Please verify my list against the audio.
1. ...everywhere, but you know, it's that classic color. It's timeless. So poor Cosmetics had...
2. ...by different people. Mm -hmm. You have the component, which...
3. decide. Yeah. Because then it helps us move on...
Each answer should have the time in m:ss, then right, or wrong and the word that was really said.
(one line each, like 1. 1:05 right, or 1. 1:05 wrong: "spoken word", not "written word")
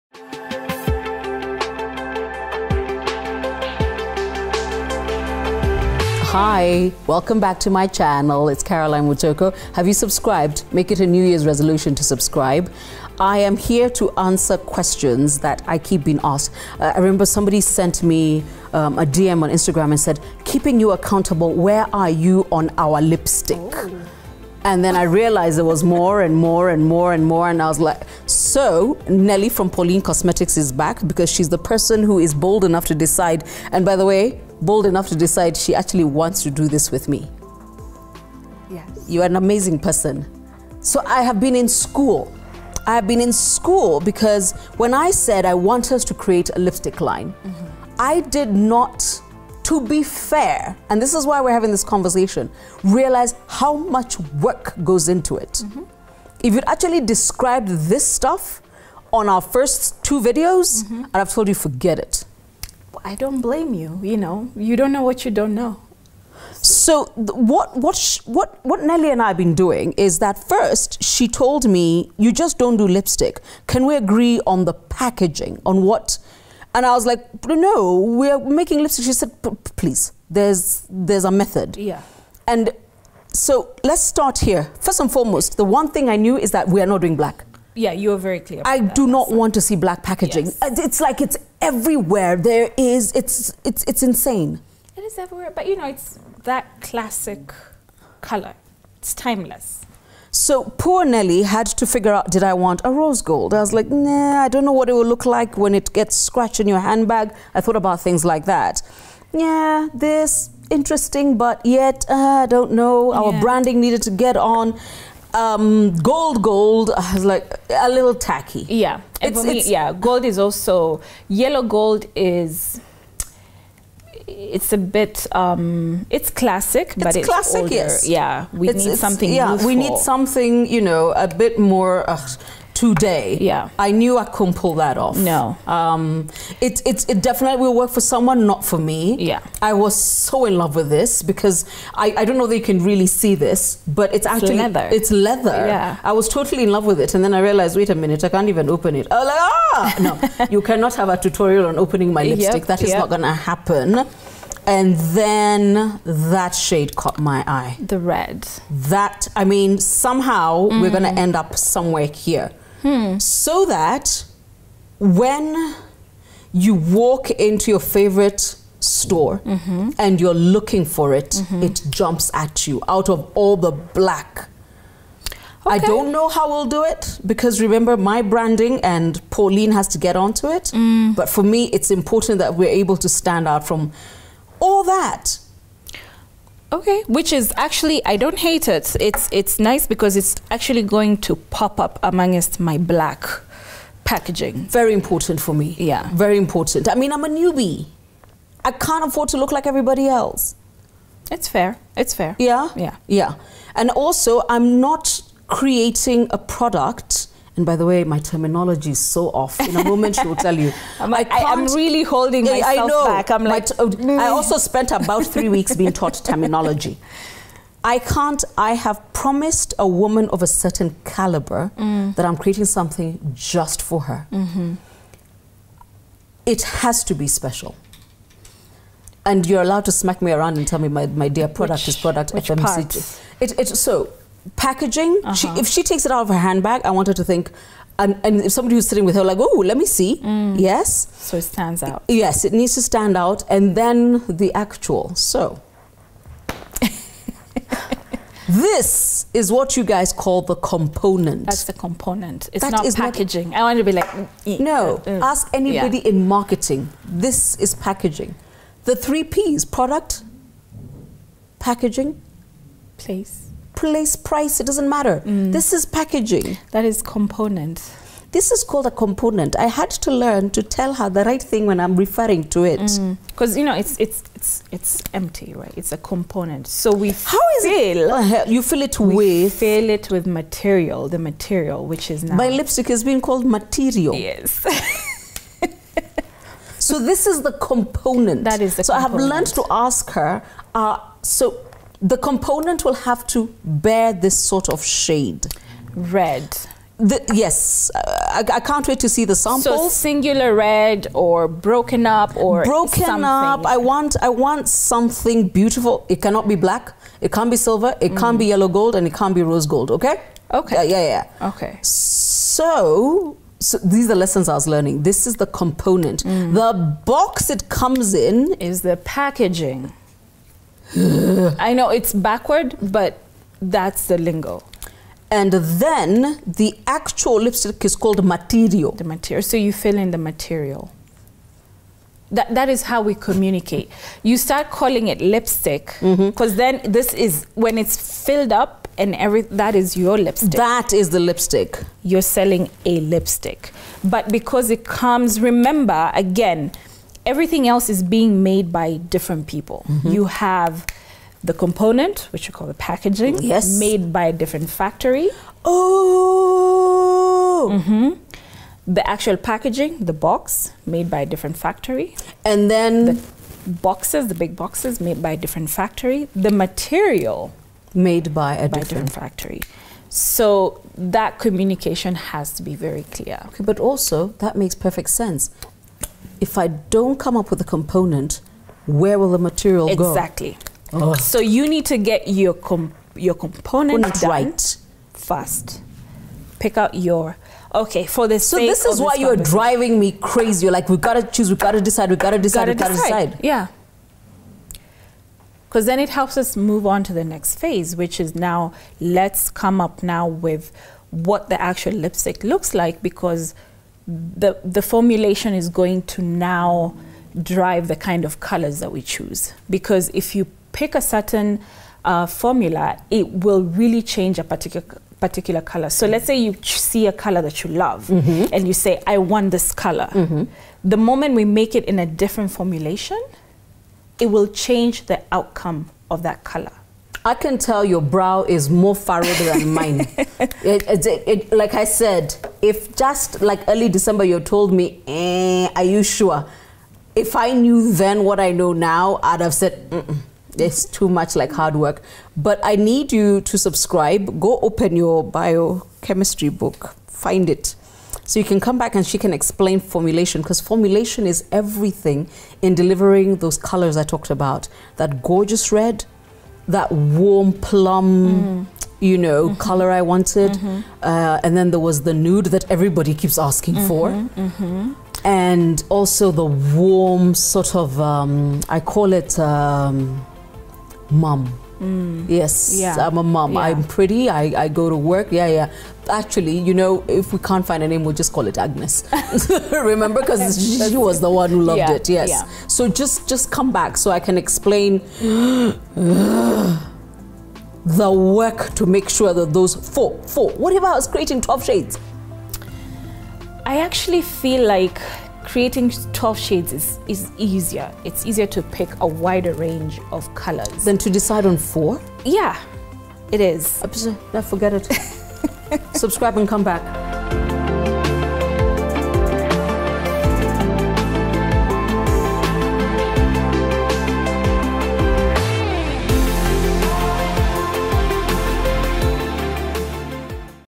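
1. 1:35 wrong: "Nelly", not "Cosmetics"
2. 5:48 right
3. 6:33 right.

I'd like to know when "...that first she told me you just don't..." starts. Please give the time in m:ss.
1:10.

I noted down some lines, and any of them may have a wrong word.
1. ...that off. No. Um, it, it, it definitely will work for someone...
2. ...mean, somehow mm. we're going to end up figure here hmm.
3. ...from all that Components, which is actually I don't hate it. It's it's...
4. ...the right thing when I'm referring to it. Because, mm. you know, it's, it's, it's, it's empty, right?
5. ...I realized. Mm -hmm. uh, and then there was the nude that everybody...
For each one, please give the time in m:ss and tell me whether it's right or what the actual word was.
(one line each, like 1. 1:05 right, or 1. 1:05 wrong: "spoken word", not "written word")
1. 2:14 right
2. 2:39 wrong: "somewhere", not "figure"
3. 3:03 wrong: "Okay", not "Components"
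4. 4:31 right
5. 7:39 wrong: "wanted", not "realized".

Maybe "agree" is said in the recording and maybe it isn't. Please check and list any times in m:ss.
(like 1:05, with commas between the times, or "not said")
1:14.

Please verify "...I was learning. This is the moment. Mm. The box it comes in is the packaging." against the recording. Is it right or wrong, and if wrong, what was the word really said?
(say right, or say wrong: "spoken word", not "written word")
wrong: "component", not "moment".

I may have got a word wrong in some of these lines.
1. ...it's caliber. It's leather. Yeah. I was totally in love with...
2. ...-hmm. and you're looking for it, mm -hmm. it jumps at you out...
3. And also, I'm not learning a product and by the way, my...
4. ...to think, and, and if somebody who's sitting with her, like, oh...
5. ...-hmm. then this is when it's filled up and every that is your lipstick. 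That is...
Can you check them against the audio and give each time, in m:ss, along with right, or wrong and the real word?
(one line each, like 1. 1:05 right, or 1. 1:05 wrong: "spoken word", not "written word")
1. 2:24 wrong: "leather", not "caliber"
2. 2:49 right
3. 3:23 wrong: "creating", not "learning"
4. 3:57 right
5. 5:36 right.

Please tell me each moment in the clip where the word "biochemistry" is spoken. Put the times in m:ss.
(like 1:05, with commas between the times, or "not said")
7:25.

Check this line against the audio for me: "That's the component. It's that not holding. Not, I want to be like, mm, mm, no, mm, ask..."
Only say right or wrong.
wrong.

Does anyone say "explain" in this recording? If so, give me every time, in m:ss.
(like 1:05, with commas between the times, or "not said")
7:29, 8:04.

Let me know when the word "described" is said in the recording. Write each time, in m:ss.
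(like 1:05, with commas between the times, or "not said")
0:57.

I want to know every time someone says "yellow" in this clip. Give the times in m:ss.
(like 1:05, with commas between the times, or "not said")
2:01, 5:08.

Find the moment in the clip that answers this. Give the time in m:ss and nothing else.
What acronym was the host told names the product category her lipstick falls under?
3:52.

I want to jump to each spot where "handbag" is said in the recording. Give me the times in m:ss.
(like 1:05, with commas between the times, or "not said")
1:46, 3:56.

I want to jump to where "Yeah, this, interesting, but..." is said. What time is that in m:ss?
1:49.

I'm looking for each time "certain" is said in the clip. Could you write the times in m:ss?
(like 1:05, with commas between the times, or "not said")
3:40, 6:51.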